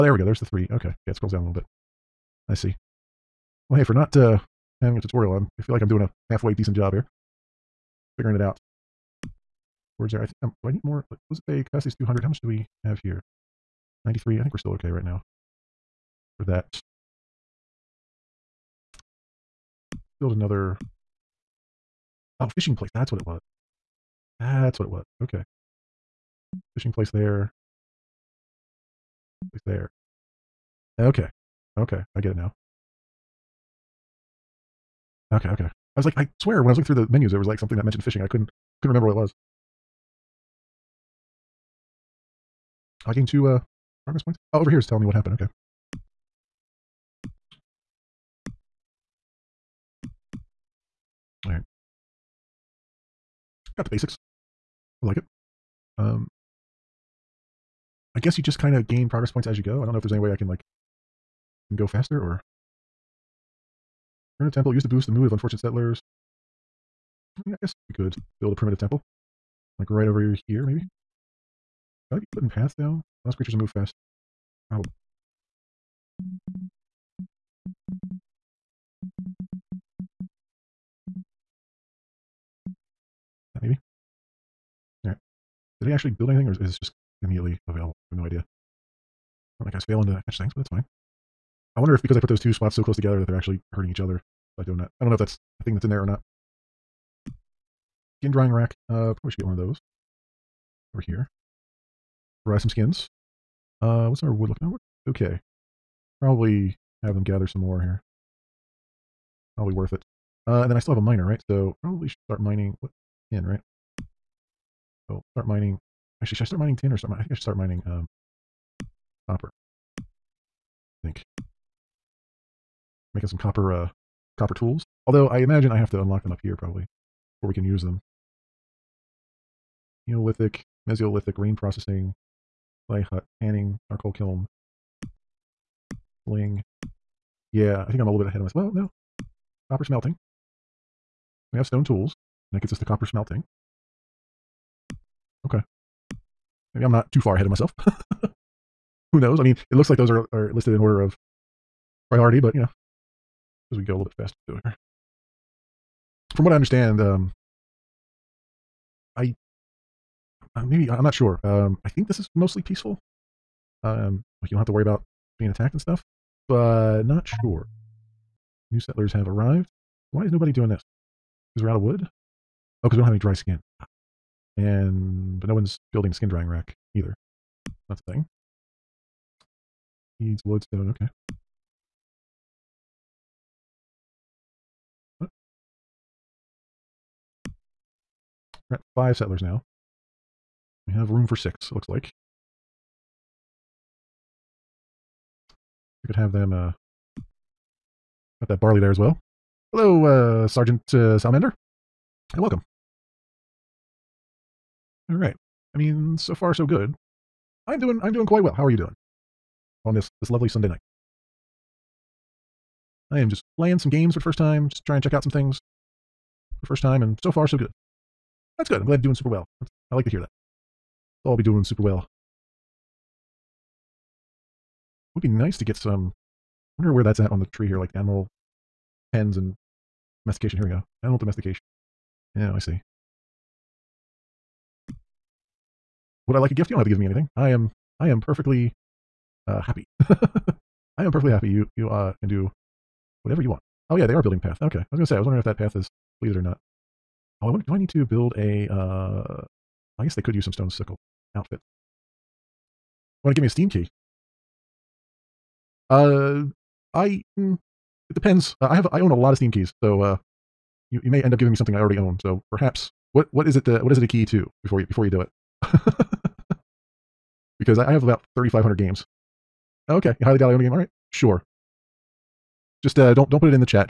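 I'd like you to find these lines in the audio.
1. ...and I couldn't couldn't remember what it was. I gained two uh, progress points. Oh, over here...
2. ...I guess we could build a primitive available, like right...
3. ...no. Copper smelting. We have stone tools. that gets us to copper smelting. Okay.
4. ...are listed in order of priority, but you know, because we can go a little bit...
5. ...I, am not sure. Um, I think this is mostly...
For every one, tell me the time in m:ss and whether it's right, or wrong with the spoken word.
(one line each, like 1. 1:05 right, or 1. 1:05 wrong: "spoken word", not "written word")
1. 0:38 right
2. 1:07 wrong: "temple", not "available"
3. 2:18 right
4. 2:30 right
5. 2:40 right.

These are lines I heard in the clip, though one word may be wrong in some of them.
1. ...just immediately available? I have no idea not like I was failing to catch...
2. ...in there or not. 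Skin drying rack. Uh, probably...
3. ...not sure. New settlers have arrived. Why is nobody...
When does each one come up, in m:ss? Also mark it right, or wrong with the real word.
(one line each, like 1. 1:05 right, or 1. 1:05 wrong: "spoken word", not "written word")
1. 1:26 right
2. 1:35 right
3. 2:47 right.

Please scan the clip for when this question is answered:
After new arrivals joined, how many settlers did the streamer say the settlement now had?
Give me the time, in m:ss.
3:08.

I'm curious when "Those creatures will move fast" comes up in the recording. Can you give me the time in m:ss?
1:13.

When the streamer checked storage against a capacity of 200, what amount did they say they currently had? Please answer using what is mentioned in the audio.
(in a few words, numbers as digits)
93.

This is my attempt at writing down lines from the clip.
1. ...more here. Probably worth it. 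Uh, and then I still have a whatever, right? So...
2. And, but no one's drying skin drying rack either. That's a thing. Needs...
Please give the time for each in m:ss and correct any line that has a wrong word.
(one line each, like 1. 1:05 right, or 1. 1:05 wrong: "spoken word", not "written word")
1. 1:47 wrong: "miner", not "whatever"
2. 2:54 wrong: "building", not "drying".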